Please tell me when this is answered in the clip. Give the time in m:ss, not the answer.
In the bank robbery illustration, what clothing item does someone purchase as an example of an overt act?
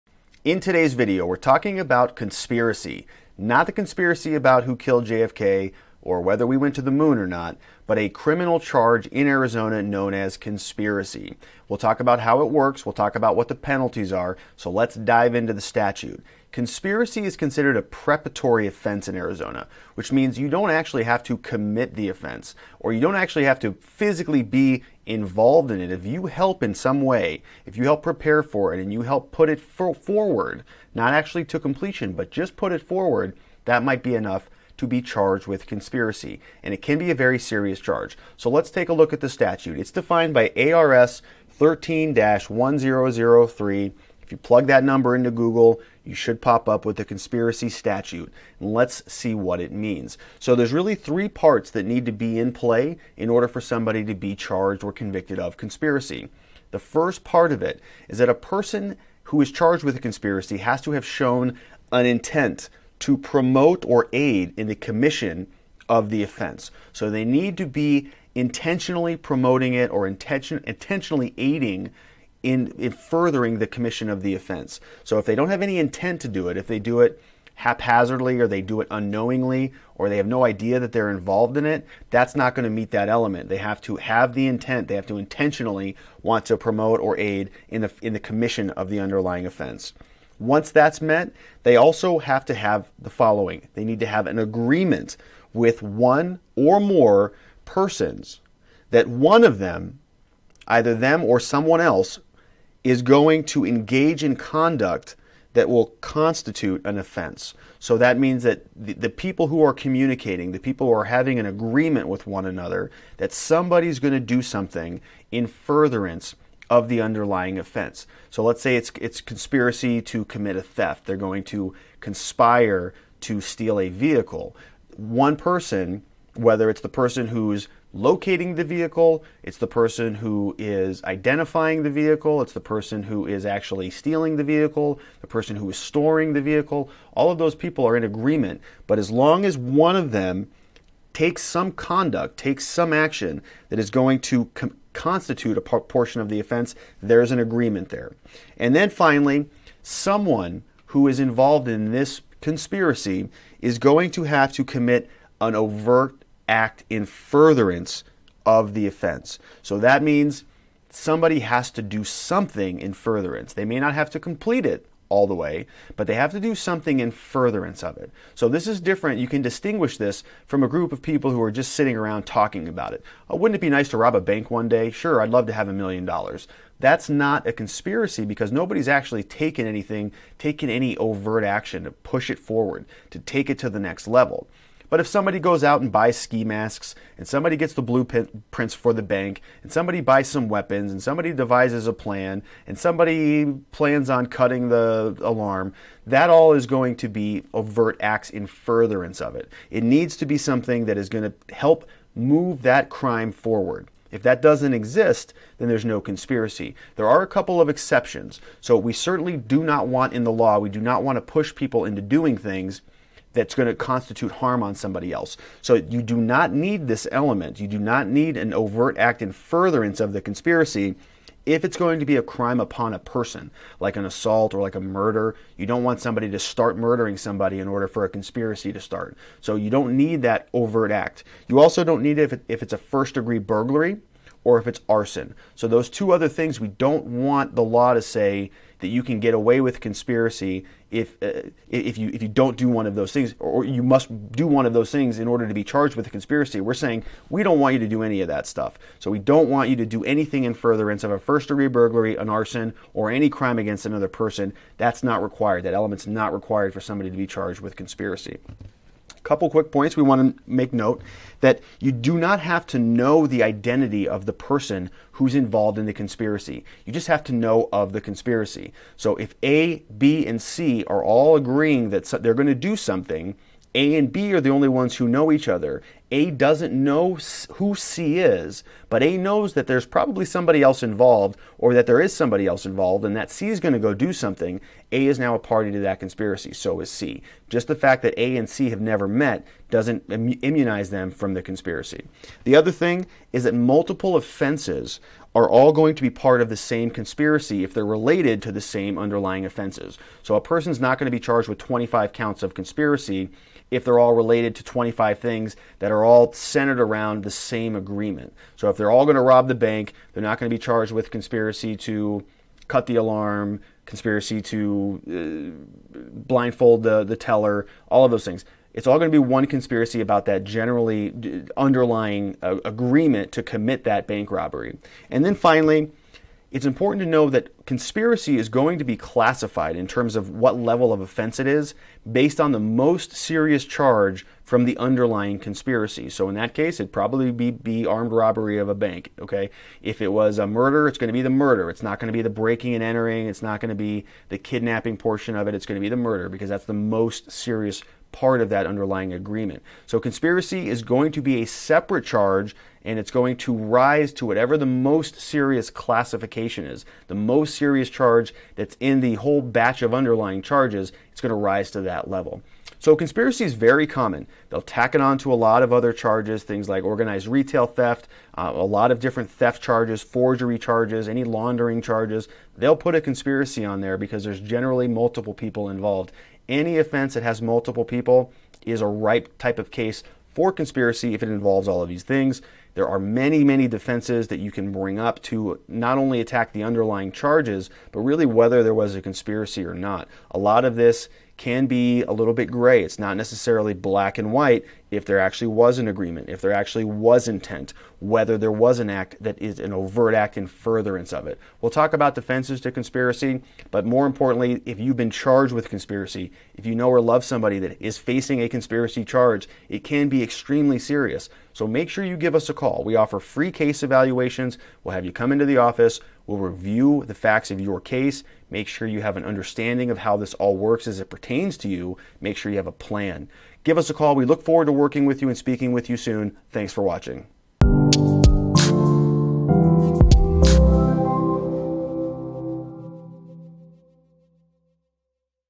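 3:06.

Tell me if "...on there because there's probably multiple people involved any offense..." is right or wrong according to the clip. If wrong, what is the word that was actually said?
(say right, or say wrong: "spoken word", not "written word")
wrong: "generally", not "probably".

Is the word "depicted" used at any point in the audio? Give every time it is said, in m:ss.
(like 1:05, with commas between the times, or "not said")
not said.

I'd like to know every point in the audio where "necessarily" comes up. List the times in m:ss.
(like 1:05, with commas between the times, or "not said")
6:33.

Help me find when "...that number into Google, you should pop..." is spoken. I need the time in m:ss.
0:44.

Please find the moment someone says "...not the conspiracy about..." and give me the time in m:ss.
0:03.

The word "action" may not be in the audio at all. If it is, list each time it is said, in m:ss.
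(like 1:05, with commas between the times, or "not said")
2:22, 3:01.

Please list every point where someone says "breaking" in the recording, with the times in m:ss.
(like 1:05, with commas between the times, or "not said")
5:42.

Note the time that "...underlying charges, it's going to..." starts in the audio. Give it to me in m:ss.
5:59.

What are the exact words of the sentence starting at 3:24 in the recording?
If that doesn't exist, then there's no conspiracy.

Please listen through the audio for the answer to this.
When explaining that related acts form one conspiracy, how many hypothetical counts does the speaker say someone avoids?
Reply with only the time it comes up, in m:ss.
5:01.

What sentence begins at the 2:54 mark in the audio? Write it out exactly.
Sure, I'd love to have a million dollars.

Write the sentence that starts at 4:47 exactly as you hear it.
Just the fact that A and C have never met doesn't immunize them from the conspiracy.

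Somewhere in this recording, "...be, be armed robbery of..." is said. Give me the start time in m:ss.
5:37.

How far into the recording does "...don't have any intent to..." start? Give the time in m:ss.
1:15.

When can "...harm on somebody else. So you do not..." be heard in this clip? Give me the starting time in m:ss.
3:34.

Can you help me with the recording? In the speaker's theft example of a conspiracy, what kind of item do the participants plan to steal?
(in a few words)
a vehicle.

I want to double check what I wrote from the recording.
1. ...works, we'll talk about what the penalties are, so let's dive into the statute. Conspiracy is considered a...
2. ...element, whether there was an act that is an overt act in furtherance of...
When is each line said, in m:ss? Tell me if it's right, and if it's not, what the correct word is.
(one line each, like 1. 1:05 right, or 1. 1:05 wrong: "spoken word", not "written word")
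1. 0:12 right
2. 6:37 wrong: "intent", not "element".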